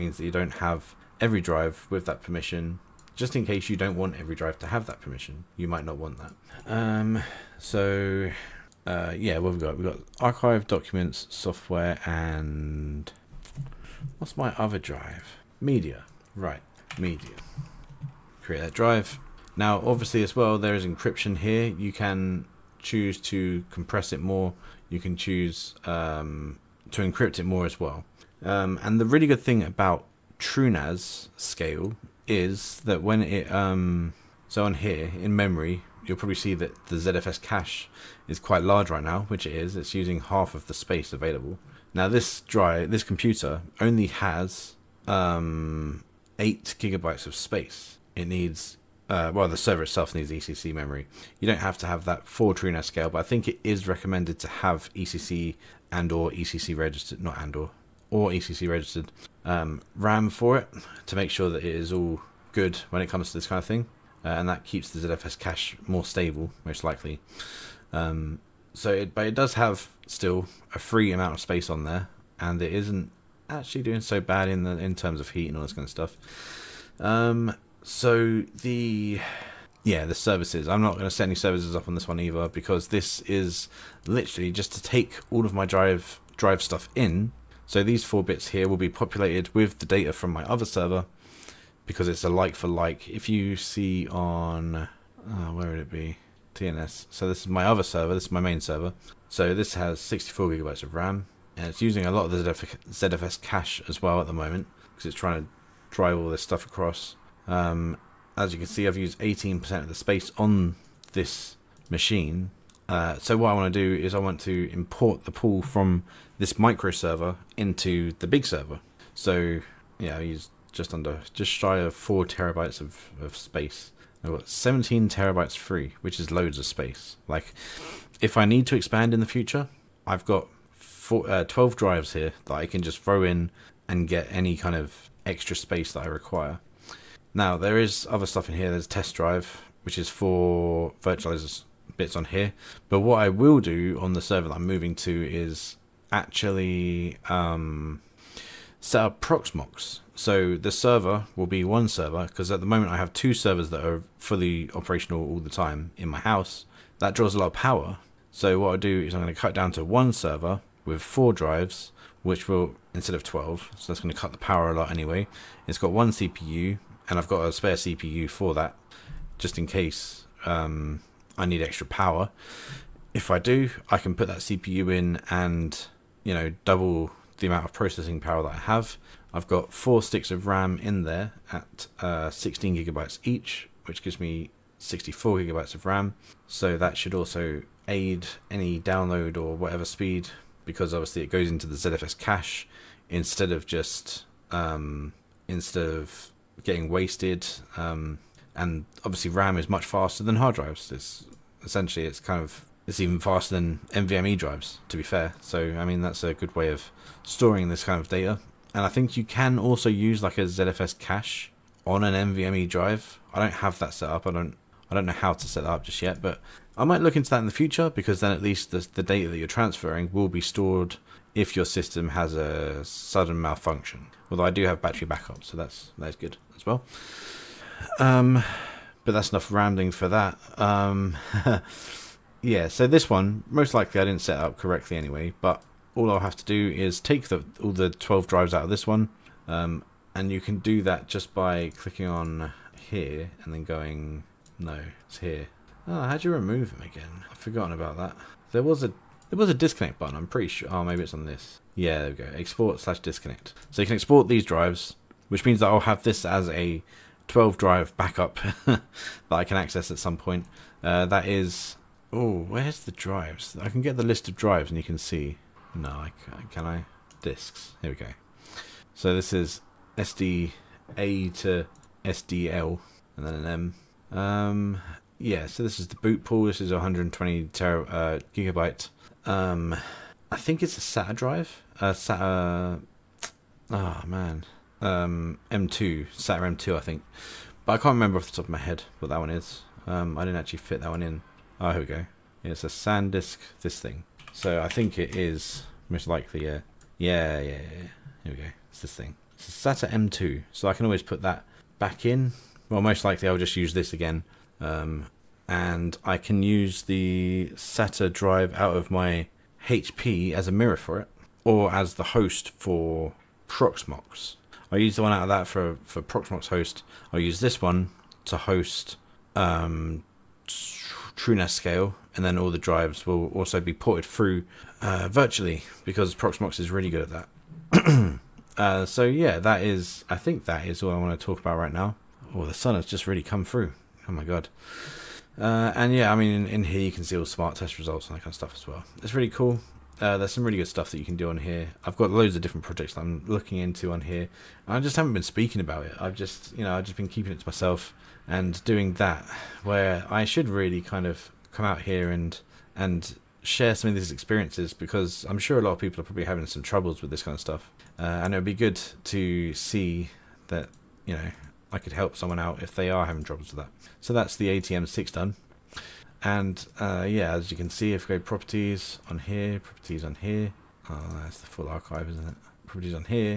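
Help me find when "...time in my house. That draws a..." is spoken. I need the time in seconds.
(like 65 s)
155 s.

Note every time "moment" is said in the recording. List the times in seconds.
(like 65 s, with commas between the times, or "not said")
104 s, 152 s.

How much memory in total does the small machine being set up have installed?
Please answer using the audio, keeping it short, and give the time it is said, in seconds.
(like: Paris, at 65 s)
8 gigabytes, at 46 s.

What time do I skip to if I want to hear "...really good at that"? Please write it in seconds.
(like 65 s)
326 s.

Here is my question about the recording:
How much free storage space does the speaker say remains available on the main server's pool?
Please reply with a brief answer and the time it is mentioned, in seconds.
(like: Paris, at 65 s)
17 terabytes, at 124 s.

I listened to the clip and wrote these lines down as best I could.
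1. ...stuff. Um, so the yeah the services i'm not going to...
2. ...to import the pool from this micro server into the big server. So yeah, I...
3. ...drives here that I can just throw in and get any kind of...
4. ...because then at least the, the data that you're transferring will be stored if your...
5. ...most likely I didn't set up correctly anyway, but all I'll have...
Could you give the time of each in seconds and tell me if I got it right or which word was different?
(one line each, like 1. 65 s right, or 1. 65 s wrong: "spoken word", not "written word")
1. 75 s right
2. 114 s right
3. 131 s right
4. 217 s right
5. 233 s right.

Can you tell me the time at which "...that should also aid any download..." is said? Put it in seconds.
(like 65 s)
186 s.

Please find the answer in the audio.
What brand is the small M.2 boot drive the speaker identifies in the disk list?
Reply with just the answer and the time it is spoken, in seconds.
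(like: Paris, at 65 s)
SanDisk, at 292 s.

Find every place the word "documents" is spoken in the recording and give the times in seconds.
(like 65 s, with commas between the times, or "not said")
10 s.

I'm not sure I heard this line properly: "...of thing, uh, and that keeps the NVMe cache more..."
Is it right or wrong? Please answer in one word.
wrong.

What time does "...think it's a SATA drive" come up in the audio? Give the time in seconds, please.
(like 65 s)
280 s.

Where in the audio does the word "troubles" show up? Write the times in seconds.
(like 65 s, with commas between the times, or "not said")
356 s, 363 s.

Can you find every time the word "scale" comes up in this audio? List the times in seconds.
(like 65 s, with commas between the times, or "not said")
31 s, 52 s, 321 s.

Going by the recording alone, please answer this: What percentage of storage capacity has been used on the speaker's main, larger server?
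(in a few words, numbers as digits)
18%.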